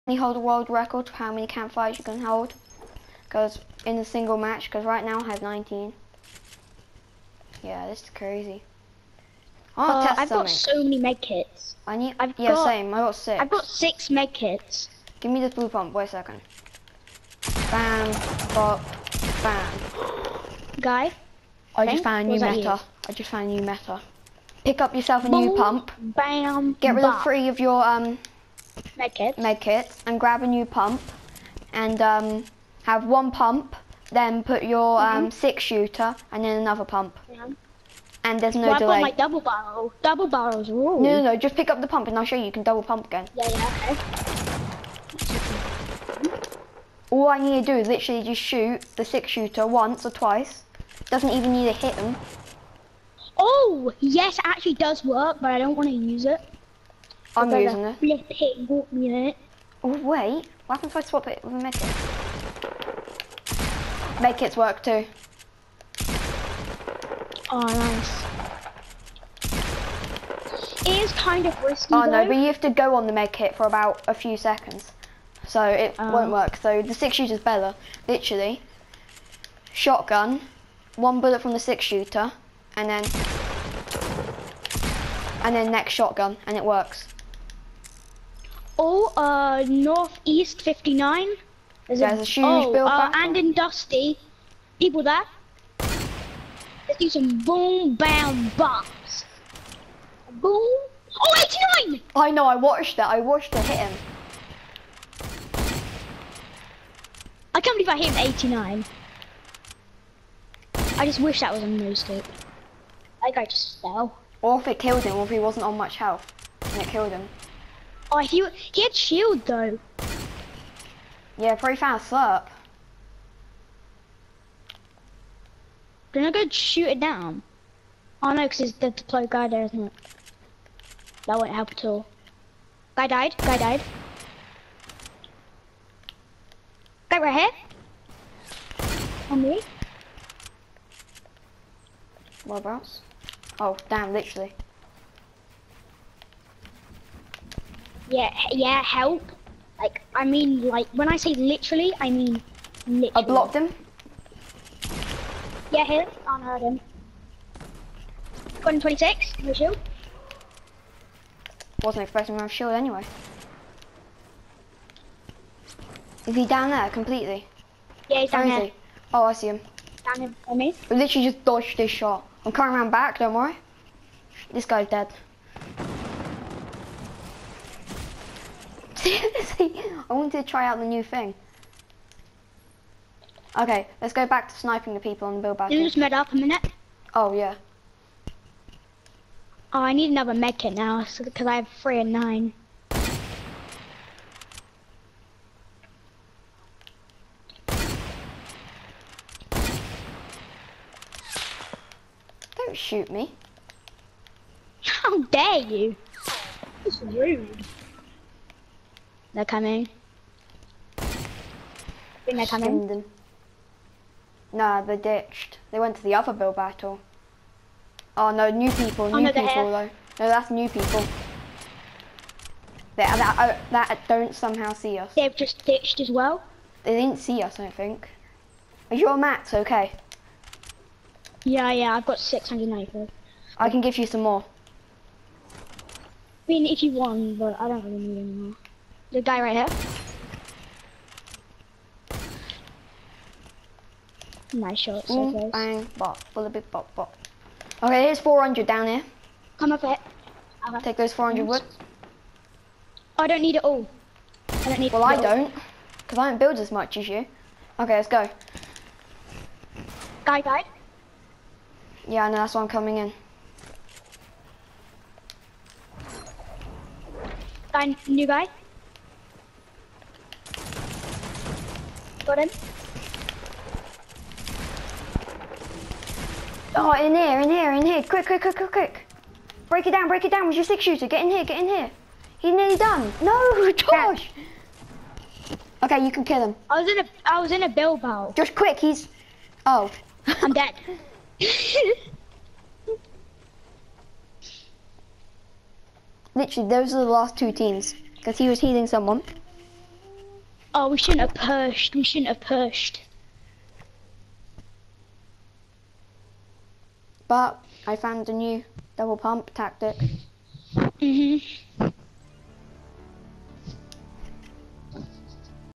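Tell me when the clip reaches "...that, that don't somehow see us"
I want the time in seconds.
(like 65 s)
223 s.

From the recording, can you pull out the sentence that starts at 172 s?
I'm coming around back, don't worry.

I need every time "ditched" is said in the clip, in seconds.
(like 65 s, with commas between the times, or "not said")
214 s, 225 s.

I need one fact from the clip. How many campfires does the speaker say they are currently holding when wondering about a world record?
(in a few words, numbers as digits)
19.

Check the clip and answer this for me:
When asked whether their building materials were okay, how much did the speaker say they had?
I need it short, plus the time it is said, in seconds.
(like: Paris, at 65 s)
694, at 232 s.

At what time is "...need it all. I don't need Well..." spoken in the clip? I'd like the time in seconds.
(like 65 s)
253 s.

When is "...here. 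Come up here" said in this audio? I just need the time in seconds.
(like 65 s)
248 s.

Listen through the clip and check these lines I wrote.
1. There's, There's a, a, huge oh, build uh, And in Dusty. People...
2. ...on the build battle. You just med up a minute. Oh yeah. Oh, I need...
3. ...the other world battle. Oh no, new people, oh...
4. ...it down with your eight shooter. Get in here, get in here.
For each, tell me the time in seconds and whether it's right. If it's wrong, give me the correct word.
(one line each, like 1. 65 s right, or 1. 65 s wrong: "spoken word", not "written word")
1. 91 s right
2. 185 s right
3. 216 s wrong: "build", not "world"
4. 280 s wrong: "six", not "eight".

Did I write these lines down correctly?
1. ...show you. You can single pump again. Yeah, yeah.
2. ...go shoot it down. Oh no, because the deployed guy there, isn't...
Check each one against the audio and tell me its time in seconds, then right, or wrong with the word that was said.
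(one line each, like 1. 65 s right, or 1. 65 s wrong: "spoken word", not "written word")
1. 42 s wrong: "double", not "single"
2. 126 s right.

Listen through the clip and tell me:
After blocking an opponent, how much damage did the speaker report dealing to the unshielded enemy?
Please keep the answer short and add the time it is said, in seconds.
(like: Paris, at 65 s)
126, at 158 s.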